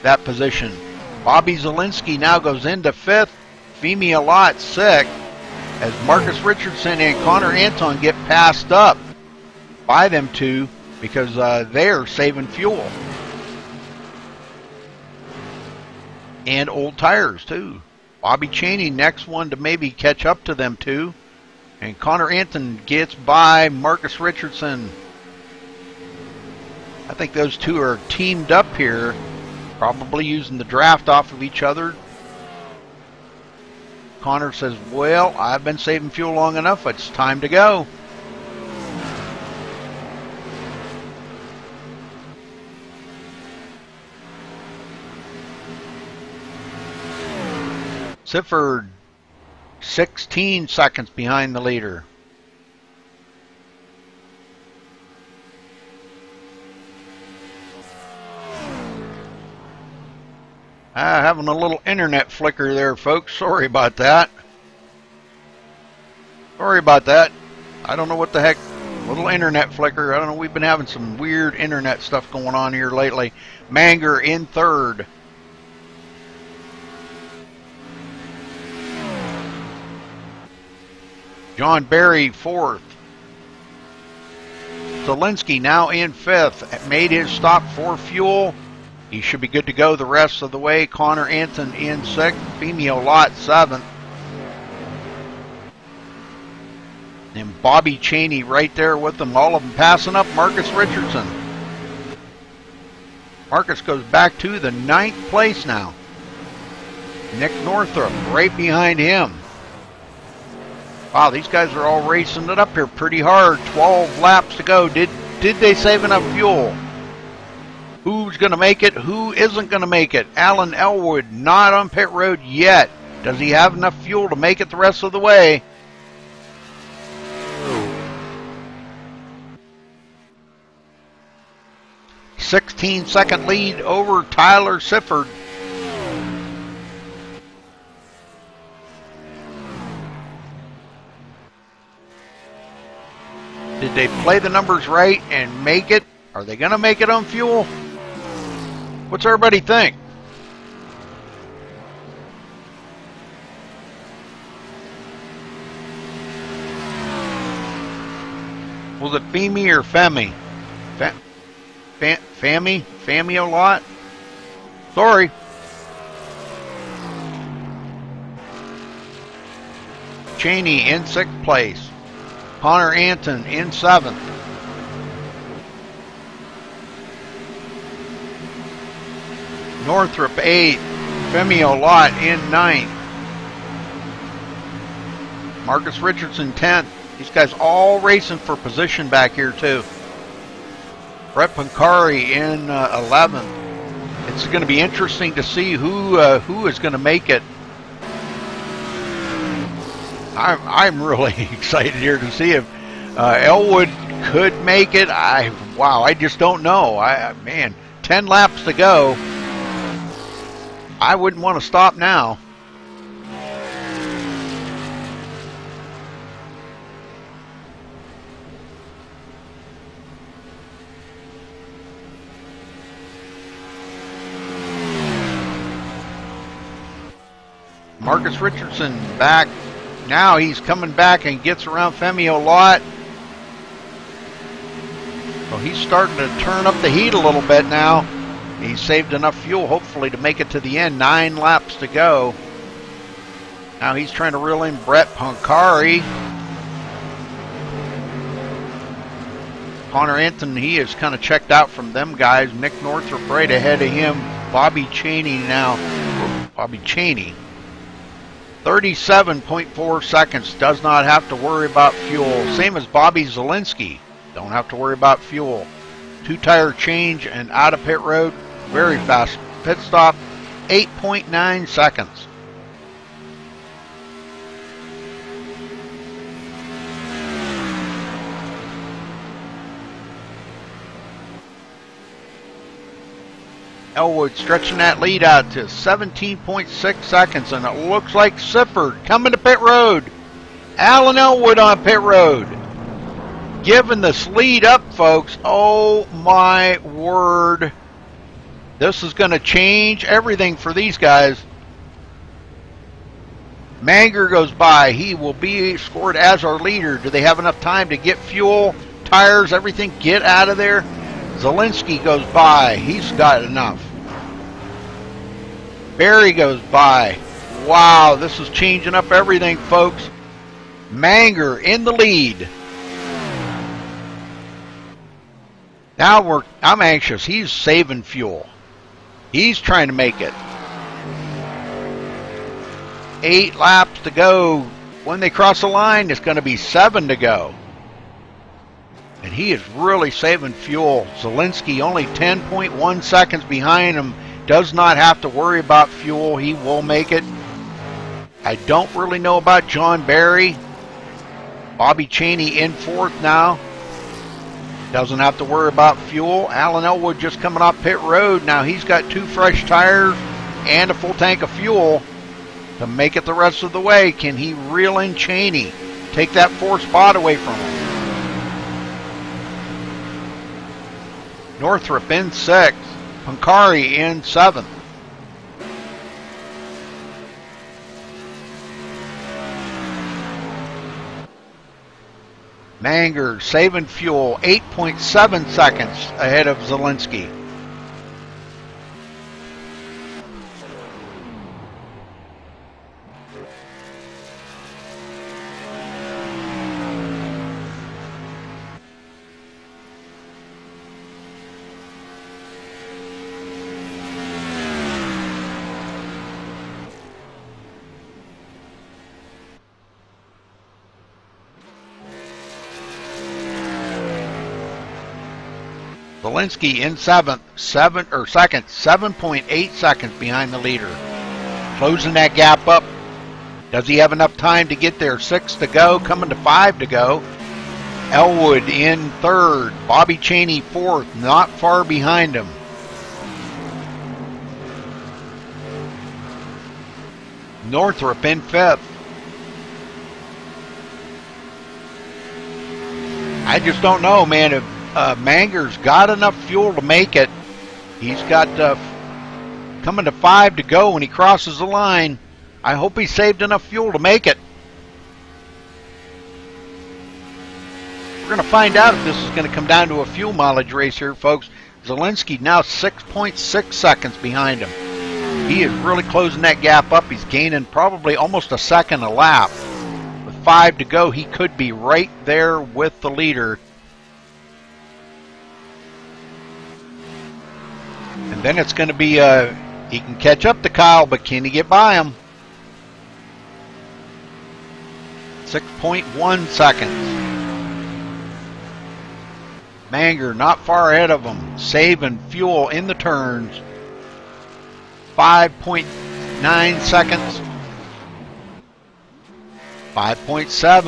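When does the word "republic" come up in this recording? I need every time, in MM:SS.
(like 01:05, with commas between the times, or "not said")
not said.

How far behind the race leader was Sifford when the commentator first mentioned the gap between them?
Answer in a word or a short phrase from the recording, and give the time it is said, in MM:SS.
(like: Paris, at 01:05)
16 seconds, at 00:49.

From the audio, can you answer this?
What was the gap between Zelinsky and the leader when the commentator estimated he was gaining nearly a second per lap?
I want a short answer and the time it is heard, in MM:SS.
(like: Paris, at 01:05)
6.6 seconds, at 07:42.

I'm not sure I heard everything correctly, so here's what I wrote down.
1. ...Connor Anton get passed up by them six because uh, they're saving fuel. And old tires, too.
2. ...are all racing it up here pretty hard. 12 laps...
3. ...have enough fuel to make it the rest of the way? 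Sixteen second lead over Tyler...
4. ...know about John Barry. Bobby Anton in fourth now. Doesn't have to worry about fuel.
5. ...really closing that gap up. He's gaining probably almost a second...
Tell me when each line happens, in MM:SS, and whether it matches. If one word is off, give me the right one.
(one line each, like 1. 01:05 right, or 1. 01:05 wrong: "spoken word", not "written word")
1. 00:07 wrong: "two", not "six"
2. 01:51 right
3. 02:03 right
4. 05:49 wrong: "Cheney", not "Anton"
5. 07:45 right.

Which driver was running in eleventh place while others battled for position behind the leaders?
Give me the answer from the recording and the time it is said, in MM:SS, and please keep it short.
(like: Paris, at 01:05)
Brett Pankari, at 03:11.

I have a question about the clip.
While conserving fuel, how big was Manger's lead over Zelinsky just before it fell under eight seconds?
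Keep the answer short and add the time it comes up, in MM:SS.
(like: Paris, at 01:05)
8.7 seconds, at 06:24.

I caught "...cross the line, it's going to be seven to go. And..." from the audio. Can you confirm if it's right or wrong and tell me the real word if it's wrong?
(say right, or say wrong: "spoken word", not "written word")
right.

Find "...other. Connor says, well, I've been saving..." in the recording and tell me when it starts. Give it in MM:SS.
00:31.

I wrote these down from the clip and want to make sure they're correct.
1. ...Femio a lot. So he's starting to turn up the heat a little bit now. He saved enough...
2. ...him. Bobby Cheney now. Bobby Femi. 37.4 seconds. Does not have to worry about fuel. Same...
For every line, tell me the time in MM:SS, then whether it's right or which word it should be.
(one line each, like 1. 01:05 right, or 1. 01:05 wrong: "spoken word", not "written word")
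1. 03:51 right
2. 04:13 wrong: "Cheney", not "Femi".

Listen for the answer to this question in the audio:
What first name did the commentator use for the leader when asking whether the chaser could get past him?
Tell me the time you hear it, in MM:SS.
08:00.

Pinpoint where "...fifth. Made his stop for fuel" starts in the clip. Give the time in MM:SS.
01:26.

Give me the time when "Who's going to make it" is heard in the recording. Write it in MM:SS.
01:58.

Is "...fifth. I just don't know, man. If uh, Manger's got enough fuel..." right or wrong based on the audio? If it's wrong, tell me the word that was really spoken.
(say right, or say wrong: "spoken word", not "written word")
right.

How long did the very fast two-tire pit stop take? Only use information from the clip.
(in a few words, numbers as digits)
8.9 seconds.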